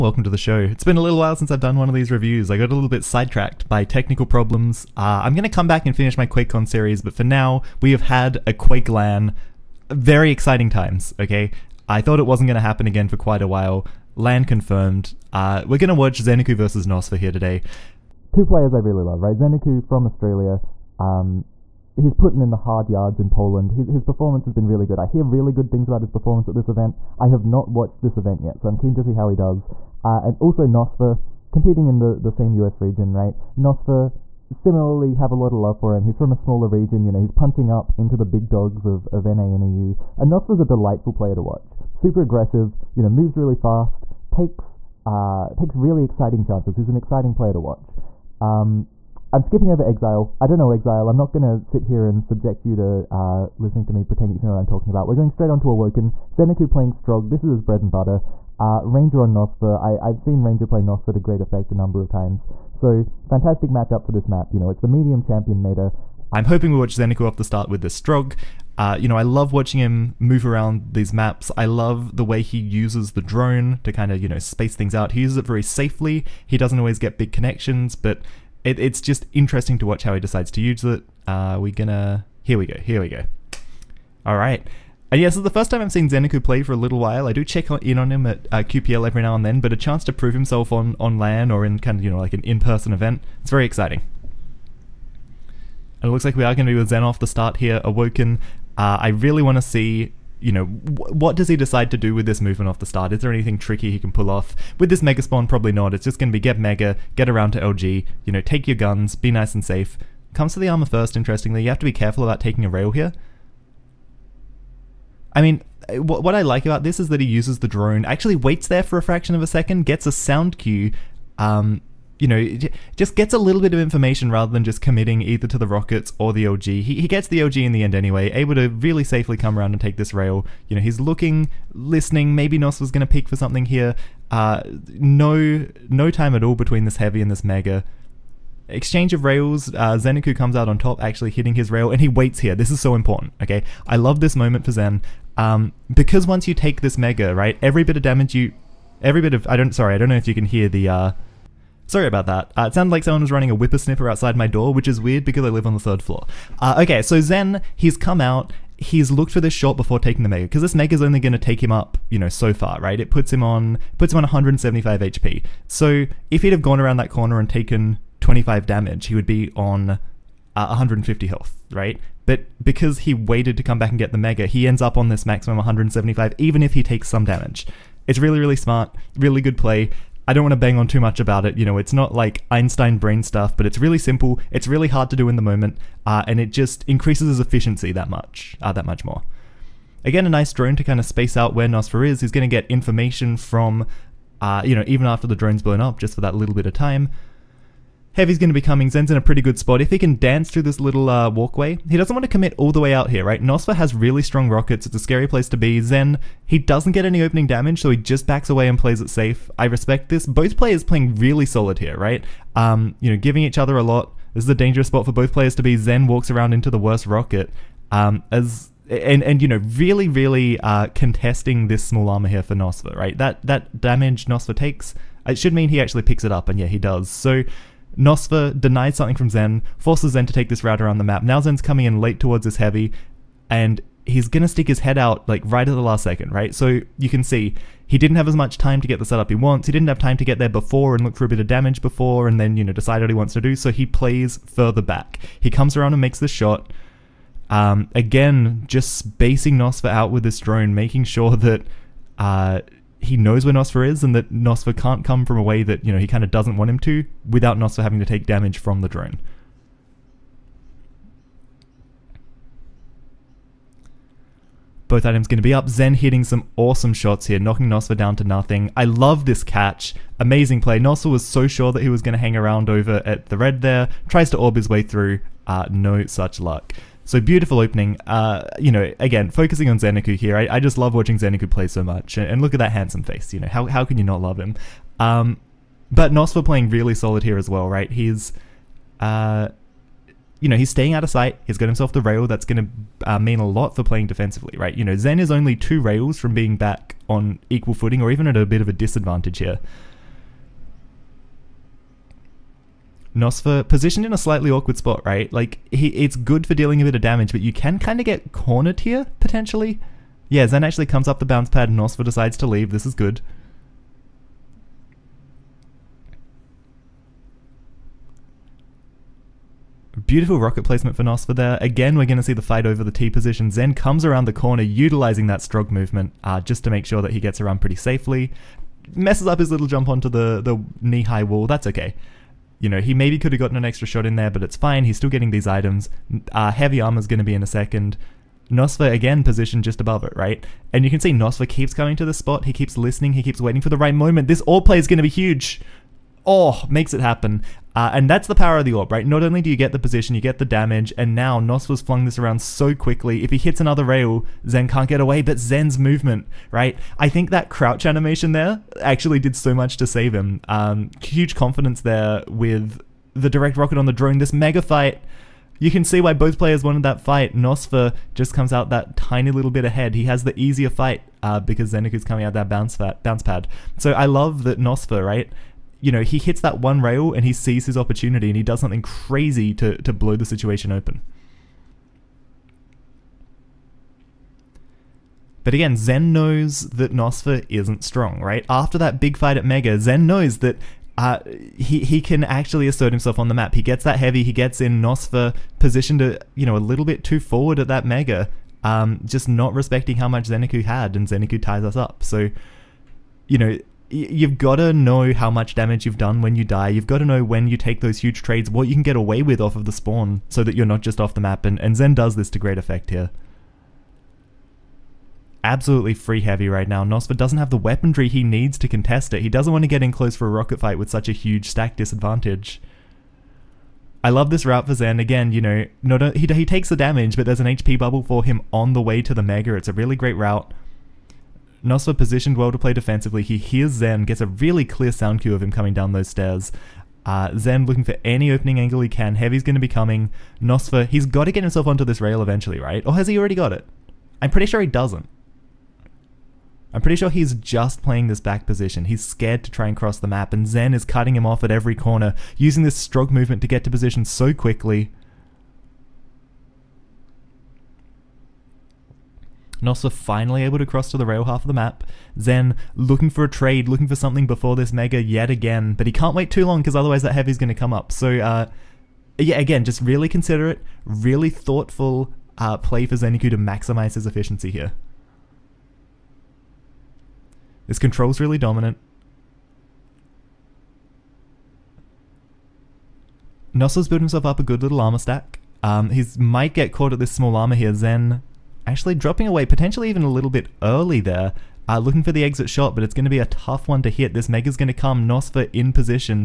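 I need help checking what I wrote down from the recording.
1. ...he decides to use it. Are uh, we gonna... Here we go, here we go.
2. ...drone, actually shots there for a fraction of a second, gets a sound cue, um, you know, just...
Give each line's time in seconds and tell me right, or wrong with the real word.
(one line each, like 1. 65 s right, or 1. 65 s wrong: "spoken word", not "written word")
1. 80 s right
2. 117 s wrong: "waits", not "shots".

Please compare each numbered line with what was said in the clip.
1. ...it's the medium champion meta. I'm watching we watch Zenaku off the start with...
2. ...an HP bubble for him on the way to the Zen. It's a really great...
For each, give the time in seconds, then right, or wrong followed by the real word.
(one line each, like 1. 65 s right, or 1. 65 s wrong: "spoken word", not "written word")
1. 64 s wrong: "hoping", not "watching"
2. 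427 s wrong: "Mega", not "Zen".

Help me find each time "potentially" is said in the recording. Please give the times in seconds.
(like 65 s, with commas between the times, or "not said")
309 s, 489 s.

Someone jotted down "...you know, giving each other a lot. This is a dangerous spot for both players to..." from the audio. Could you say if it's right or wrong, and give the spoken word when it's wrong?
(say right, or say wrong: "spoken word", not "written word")
right.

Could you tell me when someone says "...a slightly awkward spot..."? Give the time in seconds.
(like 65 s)
304 s.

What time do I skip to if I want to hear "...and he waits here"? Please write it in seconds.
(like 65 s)
141 s.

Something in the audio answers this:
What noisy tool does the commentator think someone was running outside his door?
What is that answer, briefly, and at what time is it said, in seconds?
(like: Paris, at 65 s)
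whippersnapper, at 153 s.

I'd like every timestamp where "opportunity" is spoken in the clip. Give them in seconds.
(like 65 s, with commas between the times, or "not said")
377 s.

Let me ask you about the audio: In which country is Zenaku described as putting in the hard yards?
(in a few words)
Poland.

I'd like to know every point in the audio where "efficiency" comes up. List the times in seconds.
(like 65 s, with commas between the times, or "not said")
187 s, 474 s.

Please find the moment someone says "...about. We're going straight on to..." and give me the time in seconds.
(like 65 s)
54 s.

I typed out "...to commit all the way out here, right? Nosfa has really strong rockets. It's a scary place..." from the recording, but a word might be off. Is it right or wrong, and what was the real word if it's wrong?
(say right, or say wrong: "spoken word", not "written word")
right.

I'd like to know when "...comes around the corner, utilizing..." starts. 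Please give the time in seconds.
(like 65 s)
323 s.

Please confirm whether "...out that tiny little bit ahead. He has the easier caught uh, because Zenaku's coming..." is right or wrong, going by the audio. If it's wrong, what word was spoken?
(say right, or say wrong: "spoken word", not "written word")
wrong: "fight", not "caught".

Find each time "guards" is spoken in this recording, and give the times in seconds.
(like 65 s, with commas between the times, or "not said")
not said.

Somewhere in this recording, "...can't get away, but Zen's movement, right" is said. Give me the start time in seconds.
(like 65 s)
354 s.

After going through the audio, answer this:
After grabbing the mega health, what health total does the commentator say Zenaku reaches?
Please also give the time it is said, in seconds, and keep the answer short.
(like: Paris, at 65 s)
175, at 164 s.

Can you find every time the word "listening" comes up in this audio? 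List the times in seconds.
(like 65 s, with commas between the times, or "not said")
53 s, 131 s, 342 s.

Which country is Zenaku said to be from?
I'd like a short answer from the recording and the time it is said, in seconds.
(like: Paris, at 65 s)
Australia, at 20 s.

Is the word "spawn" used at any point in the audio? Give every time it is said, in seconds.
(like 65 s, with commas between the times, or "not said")
105 s, 409 s.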